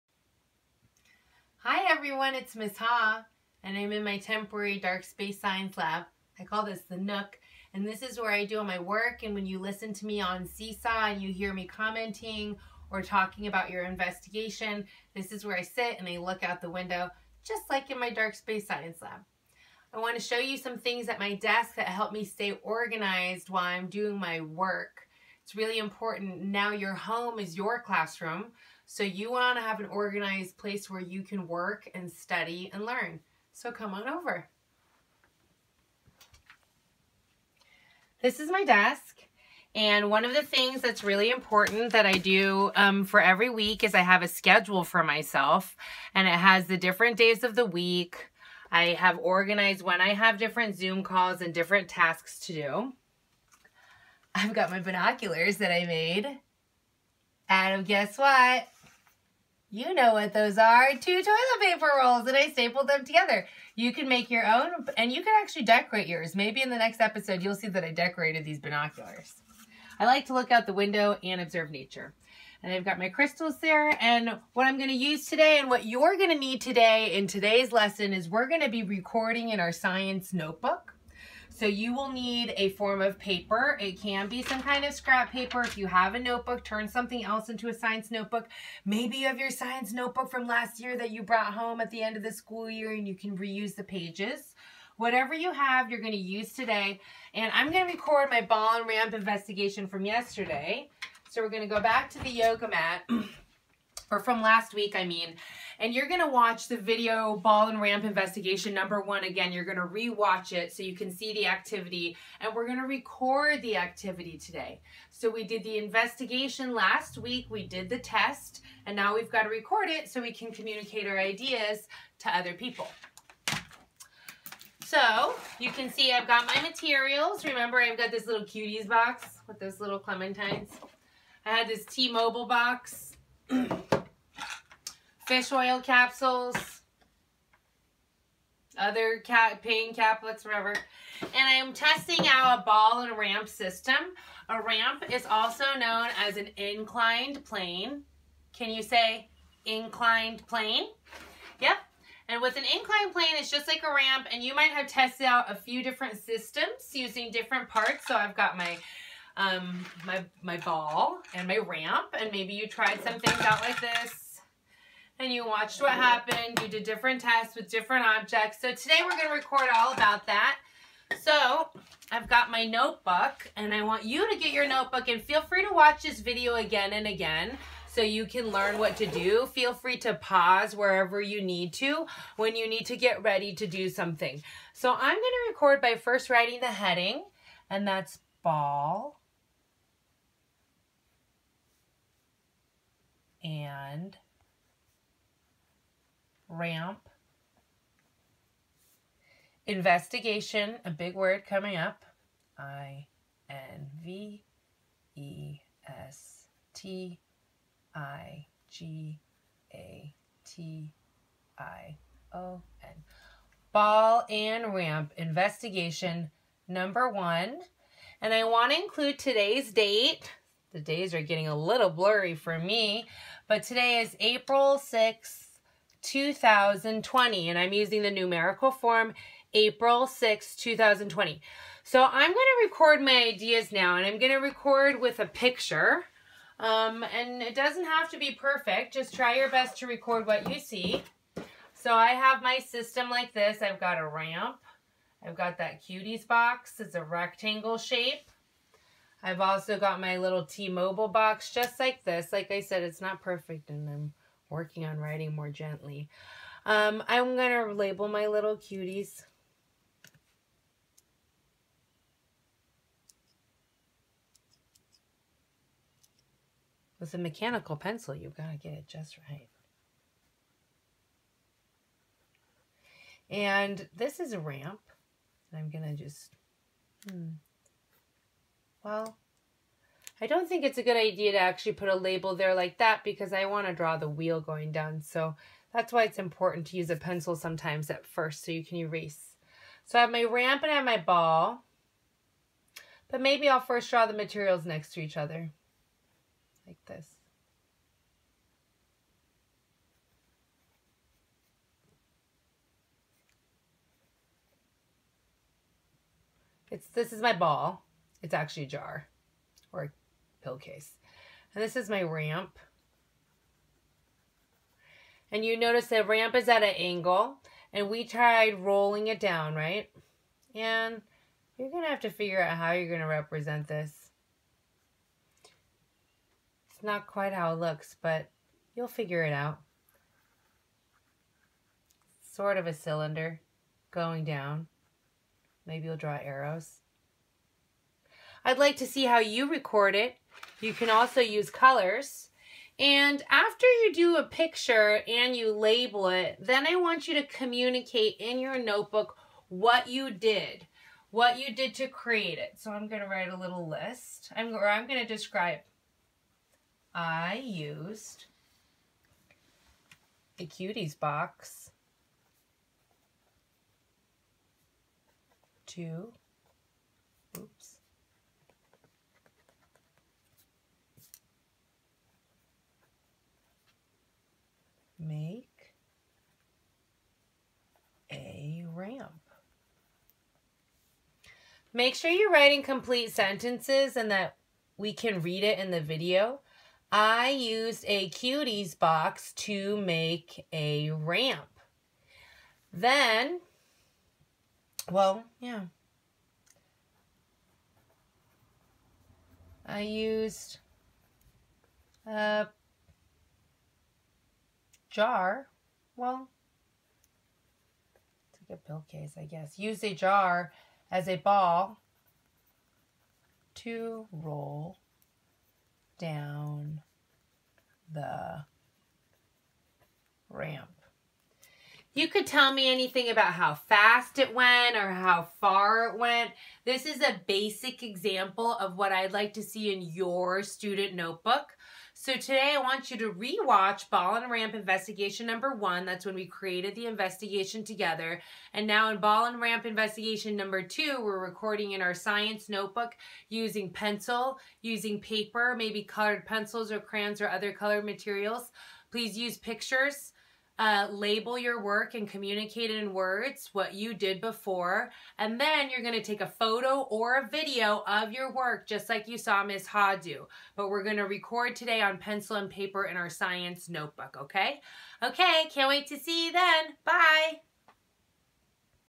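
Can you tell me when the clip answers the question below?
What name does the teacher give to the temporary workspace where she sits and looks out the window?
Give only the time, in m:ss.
0:06.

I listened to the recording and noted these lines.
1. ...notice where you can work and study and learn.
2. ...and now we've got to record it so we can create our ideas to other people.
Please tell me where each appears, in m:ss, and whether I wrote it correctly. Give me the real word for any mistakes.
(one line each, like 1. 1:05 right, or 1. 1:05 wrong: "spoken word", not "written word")
1. 0:30 wrong: "place", not "notice"
2. 1:58 wrong: "communicate", not "create".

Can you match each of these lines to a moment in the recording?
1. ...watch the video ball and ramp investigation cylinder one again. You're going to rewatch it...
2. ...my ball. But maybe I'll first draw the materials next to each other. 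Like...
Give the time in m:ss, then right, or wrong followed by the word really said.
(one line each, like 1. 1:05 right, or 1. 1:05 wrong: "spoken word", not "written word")
1. 1:46 wrong: "number", not "cylinder"
2. 4:50 right.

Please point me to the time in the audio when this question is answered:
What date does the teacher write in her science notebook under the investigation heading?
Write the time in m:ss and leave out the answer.
3:44.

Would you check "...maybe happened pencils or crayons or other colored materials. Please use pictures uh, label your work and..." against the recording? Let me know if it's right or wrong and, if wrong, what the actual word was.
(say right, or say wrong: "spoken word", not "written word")
wrong: "colored", not "happened".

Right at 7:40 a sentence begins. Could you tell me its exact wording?
But we're going to record today on pencil and paper in our science notebook, okay?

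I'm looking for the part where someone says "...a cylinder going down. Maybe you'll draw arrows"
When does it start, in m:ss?
5:32.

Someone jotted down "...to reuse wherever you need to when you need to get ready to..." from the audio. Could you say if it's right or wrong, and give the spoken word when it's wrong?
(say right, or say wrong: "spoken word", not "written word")
wrong: "pause", not "reuse".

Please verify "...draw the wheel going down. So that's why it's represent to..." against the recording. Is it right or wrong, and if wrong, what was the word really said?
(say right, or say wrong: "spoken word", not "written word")
wrong: "important", not "represent".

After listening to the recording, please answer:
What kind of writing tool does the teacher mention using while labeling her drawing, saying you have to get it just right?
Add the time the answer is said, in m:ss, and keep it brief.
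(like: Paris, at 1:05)
mechanical pencil, at 4:27.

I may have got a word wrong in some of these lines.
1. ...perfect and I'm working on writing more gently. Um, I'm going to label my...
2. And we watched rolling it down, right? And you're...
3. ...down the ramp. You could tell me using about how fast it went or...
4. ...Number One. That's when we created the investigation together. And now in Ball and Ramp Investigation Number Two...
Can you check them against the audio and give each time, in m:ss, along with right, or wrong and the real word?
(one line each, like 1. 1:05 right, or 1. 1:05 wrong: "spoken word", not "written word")
1. 4:13 right
2. 5:17 wrong: "tried", not "watched"
3. 6:55 wrong: "anything", not "using"
4. 7:15 right.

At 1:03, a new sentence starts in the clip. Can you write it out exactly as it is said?
You can make your own, and you can actually decorate yours.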